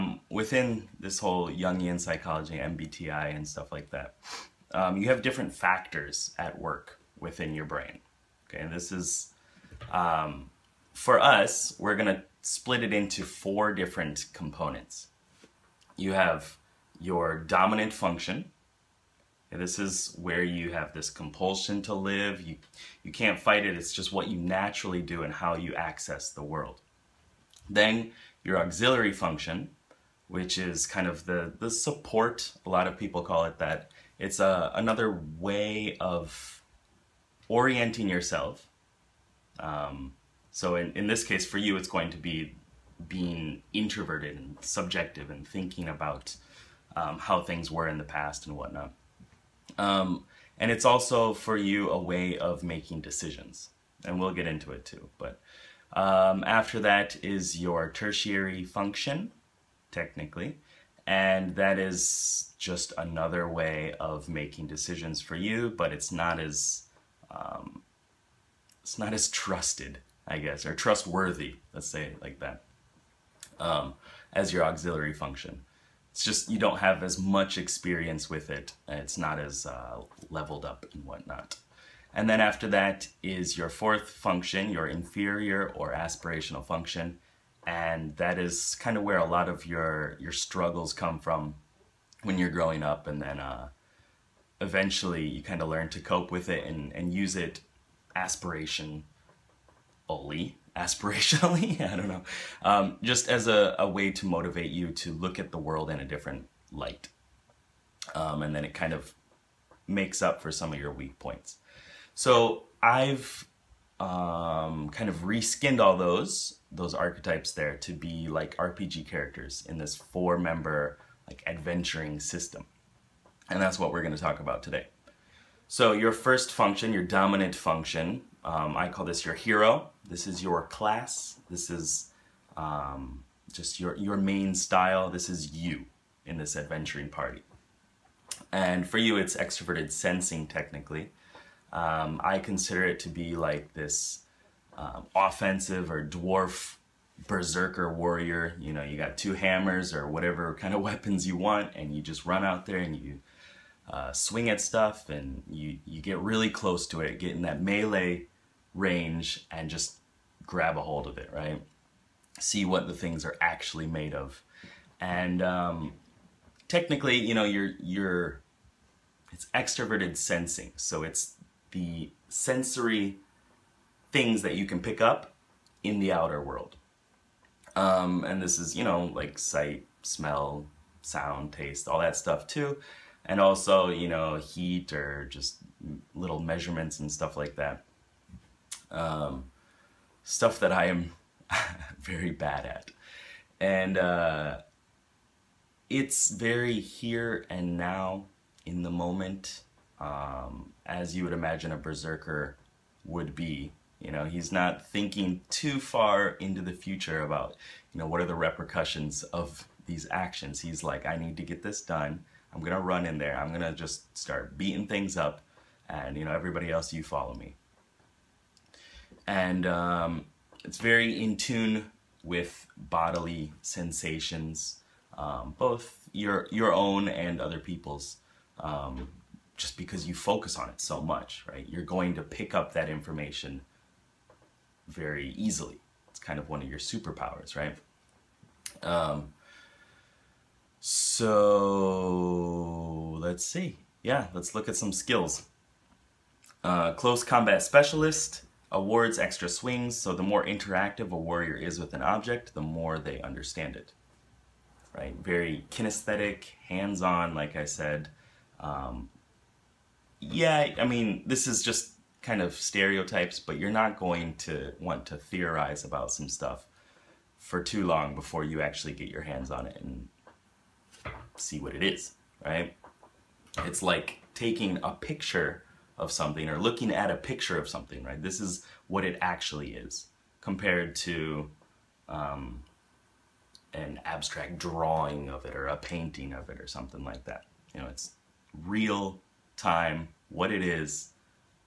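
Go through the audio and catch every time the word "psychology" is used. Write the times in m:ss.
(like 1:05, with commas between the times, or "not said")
0:01.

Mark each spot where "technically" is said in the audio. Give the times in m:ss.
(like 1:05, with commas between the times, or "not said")
0:59, 2:20, 2:46.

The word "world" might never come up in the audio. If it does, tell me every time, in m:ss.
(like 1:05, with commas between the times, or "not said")
0:26, 1:45, 2:56.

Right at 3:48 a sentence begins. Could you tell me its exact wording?
Um, just because you focus on it so much, right?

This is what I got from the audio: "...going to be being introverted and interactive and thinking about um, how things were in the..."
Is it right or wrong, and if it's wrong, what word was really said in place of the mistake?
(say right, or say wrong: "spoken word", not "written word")
wrong: "subjective", not "interactive".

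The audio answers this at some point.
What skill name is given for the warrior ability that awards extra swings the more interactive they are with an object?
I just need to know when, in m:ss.
4:06.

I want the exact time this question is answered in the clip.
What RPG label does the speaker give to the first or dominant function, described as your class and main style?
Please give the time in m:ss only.
2:09.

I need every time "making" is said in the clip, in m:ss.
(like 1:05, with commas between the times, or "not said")
0:52, 1:04.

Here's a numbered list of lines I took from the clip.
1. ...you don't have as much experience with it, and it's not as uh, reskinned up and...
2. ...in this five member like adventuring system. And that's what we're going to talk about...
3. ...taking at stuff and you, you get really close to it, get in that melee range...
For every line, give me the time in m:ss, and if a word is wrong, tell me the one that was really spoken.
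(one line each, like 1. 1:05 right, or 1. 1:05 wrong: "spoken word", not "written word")
1. 1:16 wrong: "leveled", not "reskinned"
2. 1:59 wrong: "four", not "five"
3. 2:34 wrong: "swing", not "taking".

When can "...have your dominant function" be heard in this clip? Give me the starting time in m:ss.
0:16.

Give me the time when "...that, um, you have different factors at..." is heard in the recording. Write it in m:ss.
0:03.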